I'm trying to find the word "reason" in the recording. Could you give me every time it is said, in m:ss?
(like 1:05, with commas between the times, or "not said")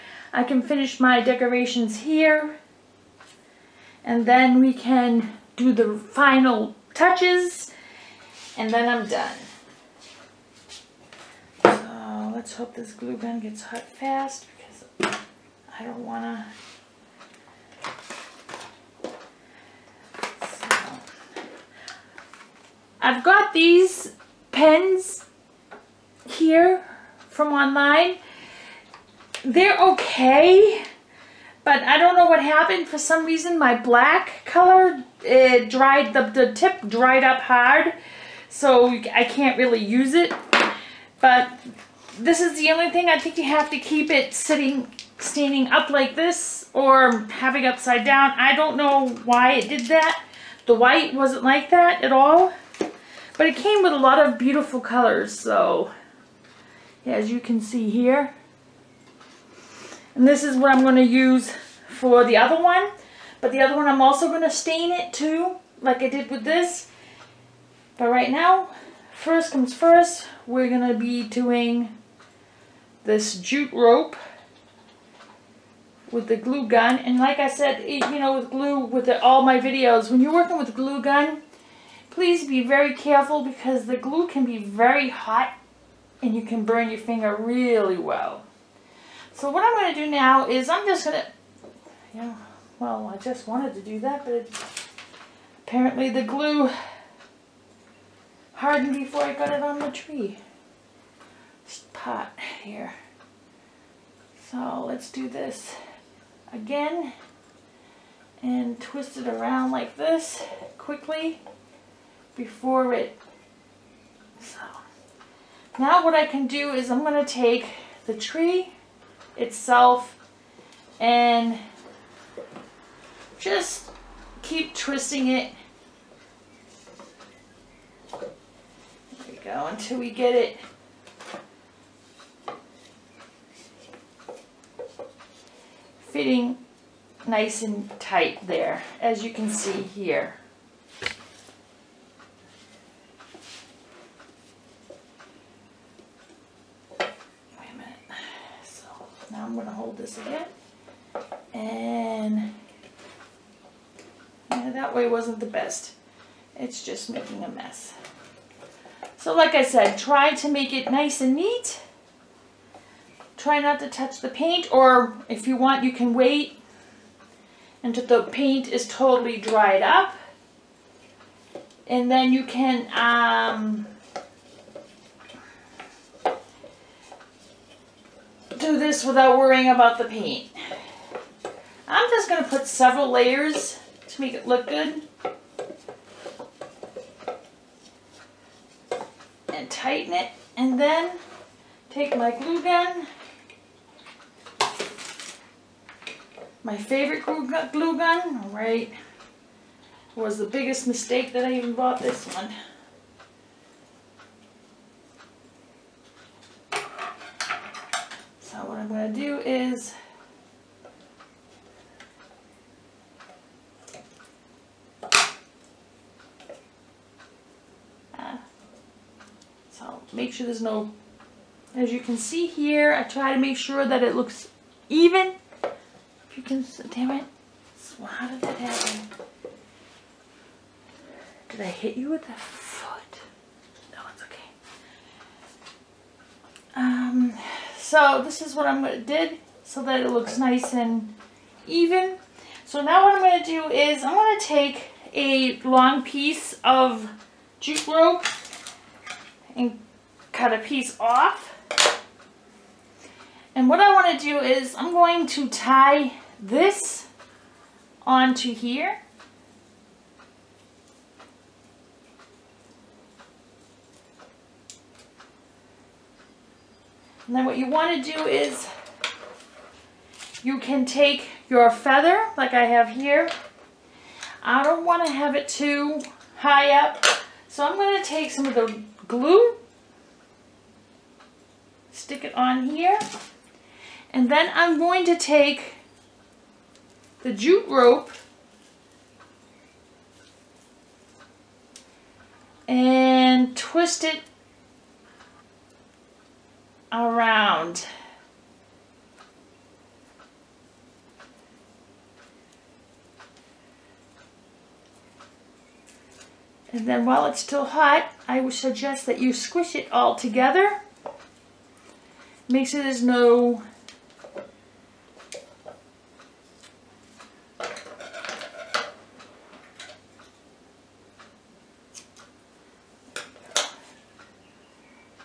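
0:33.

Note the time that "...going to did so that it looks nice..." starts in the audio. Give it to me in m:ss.
3:58.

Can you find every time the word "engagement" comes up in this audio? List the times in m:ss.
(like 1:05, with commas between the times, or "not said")
not said.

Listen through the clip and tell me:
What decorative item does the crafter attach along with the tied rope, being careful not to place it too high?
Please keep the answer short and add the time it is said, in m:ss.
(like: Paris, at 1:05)
feather, at 4:31.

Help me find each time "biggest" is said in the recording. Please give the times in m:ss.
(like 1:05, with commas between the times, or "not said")
3:20.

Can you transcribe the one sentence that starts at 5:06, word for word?
And then while it's still hot, I would suggest that you squish it all together.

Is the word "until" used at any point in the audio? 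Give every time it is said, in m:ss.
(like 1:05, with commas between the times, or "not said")
2:09, 2:47.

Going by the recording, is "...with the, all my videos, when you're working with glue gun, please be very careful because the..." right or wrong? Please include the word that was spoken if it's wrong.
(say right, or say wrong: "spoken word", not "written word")
right.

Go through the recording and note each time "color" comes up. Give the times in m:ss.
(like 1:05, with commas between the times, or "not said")
0:34, 0:54.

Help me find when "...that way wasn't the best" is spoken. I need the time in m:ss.
2:34.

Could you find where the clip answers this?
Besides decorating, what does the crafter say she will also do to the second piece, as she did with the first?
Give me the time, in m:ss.
1:04.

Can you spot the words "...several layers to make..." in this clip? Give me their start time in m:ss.
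3:02.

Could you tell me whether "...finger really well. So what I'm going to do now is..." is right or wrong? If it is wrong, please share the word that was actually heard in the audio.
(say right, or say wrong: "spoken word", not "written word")
right.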